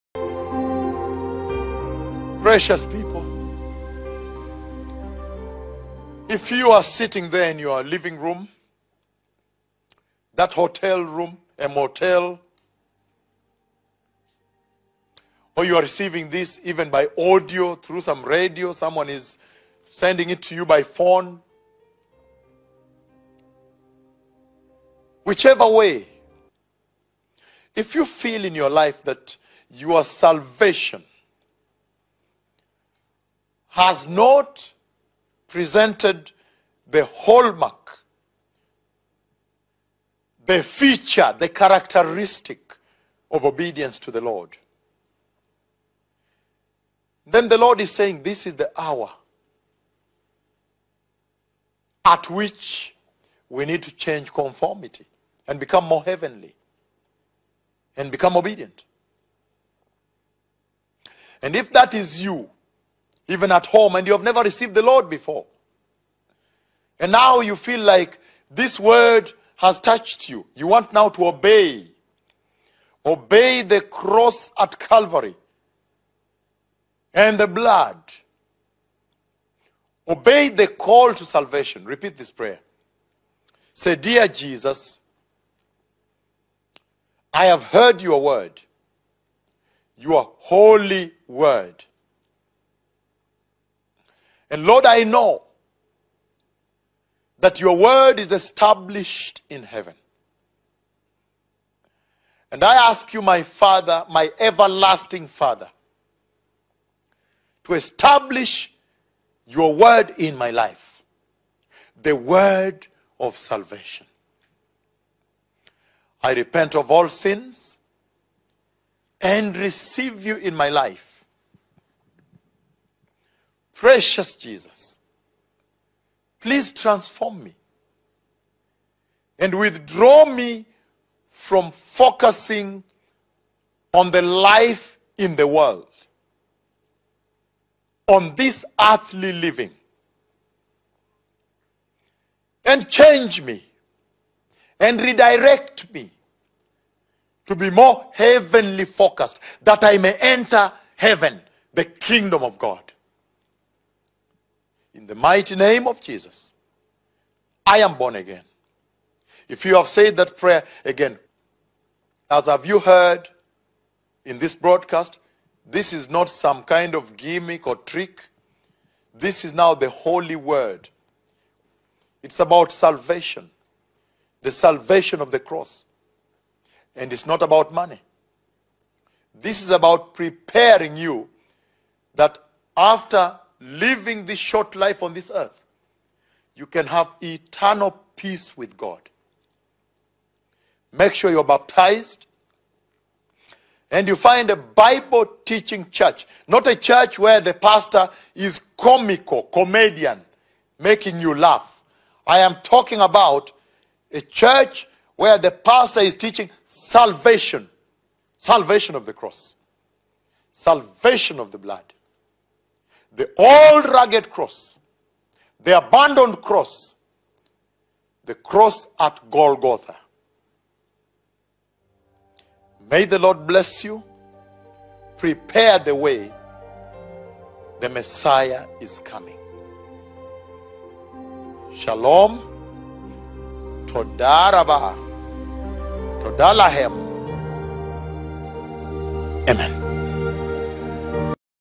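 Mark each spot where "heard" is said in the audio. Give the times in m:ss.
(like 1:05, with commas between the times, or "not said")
1:27, 2:42.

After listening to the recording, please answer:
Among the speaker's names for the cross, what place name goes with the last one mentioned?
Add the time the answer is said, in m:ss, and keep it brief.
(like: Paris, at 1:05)
Golgotha, at 3:39.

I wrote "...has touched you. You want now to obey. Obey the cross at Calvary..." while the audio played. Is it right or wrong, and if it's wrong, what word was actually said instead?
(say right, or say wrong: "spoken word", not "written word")
right.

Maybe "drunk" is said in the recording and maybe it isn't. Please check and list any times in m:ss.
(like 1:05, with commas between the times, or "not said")
not said.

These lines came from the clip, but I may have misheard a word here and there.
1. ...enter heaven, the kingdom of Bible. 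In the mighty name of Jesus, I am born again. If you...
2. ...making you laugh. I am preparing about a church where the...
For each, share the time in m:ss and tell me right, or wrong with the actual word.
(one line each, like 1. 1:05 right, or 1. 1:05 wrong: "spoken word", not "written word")
1. 2:30 wrong: "God", not "Bible"
2. 3:20 wrong: "talking", not "preparing".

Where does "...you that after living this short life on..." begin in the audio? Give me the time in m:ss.
3:00.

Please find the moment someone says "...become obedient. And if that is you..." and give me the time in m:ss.
0:58.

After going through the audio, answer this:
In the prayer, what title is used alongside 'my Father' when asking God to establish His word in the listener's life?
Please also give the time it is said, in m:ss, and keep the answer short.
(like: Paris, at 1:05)
Everlasting Father, at 1:44.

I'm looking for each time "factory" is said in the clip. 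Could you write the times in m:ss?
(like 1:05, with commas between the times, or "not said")
not said.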